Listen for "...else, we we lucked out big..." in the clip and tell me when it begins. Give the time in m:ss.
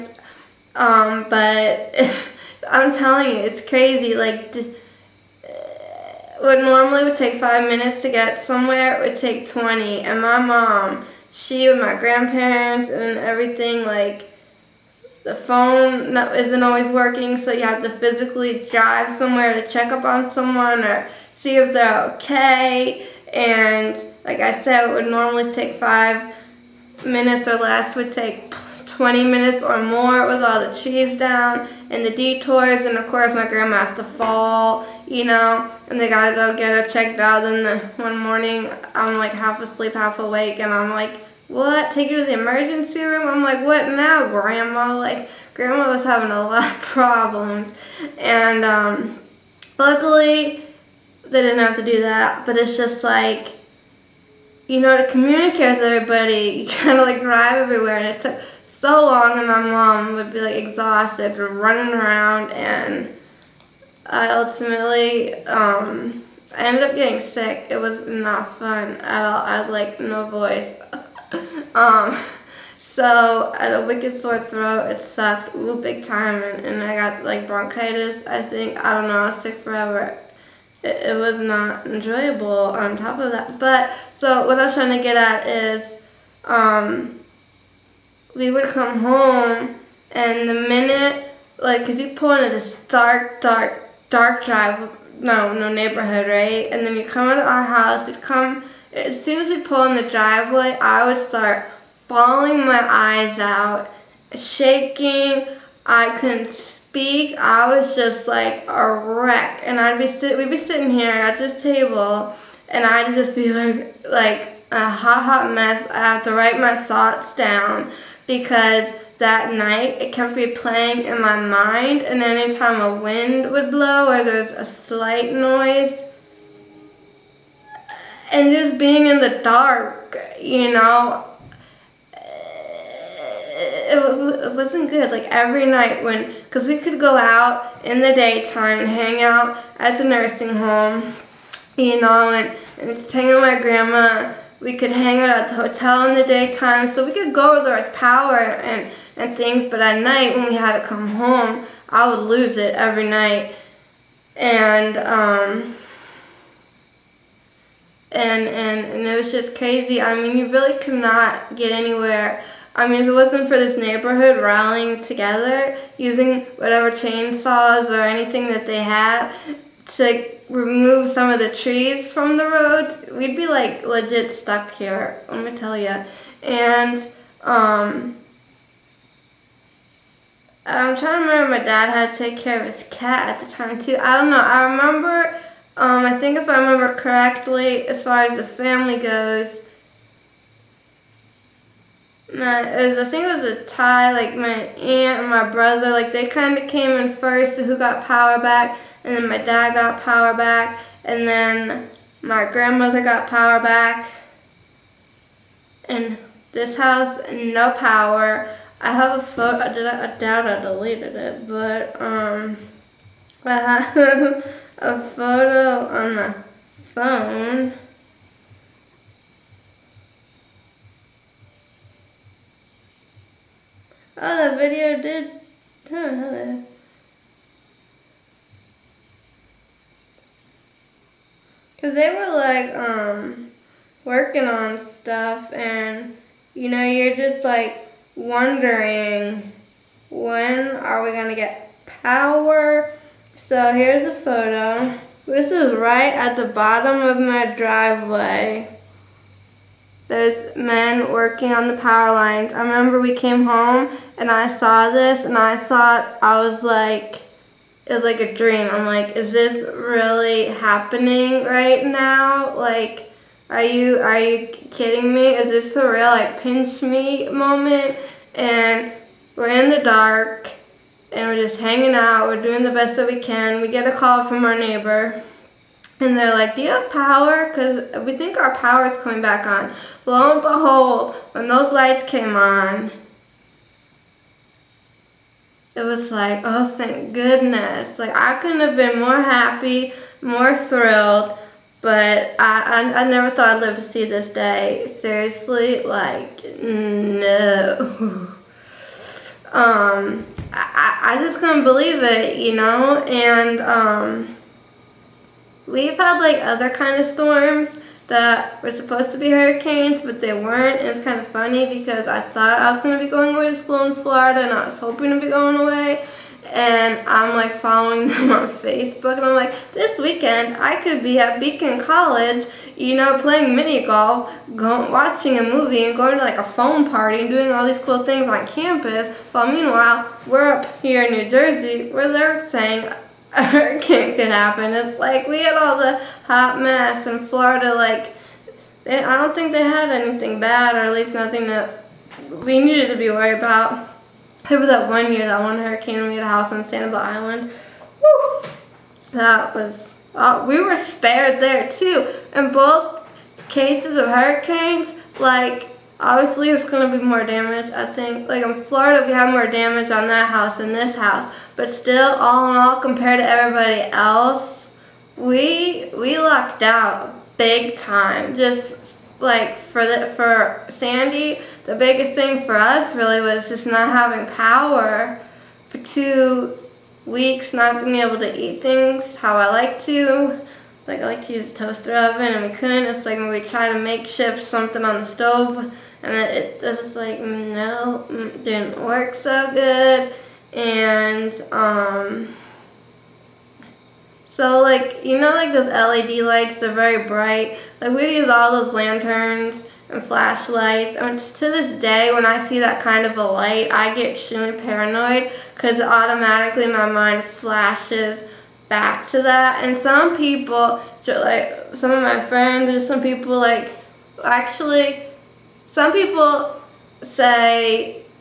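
6:03.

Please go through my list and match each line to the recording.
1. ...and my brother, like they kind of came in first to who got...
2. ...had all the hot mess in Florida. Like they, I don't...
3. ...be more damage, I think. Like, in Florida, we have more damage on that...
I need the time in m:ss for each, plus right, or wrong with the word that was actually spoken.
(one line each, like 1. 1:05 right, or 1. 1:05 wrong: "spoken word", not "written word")
1. 3:15 right
2. 5:35 right
3. 5:56 right.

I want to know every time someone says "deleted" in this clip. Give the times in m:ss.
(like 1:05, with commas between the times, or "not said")
3:30.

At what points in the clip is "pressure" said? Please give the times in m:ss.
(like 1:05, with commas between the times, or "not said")
not said.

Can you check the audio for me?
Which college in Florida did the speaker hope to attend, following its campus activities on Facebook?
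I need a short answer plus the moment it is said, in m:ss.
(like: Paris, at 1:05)
Beacon College, at 5:21.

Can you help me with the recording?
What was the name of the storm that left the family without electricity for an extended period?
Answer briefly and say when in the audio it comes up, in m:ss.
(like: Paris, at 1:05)
Sandy, at 6:10.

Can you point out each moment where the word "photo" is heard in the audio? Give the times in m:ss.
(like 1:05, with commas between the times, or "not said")
3:29, 3:34, 4:04.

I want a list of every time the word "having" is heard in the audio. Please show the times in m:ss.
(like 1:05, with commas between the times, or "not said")
0:46, 6:13.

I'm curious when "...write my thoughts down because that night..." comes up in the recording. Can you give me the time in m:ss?
1:56.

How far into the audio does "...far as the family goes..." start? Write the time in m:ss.
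3:08.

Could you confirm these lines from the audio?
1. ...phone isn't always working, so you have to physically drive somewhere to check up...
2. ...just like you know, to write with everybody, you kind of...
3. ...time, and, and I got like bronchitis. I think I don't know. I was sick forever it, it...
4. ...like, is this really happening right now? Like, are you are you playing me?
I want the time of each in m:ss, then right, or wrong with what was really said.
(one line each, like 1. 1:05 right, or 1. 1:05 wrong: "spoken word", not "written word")
1. 0:15 right
2. 0:52 wrong: "communicate", not "write"
3. 1:16 right
4. 4:18 wrong: "kidding", not "playing".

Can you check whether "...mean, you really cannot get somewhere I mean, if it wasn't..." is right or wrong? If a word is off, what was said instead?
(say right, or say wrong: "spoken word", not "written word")
wrong: "anywhere", not "somewhere".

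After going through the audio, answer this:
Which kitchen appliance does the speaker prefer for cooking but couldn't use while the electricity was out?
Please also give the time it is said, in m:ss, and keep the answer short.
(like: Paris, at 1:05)
toaster oven, at 6:21.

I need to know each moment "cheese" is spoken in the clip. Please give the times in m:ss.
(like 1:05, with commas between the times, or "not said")
0:30.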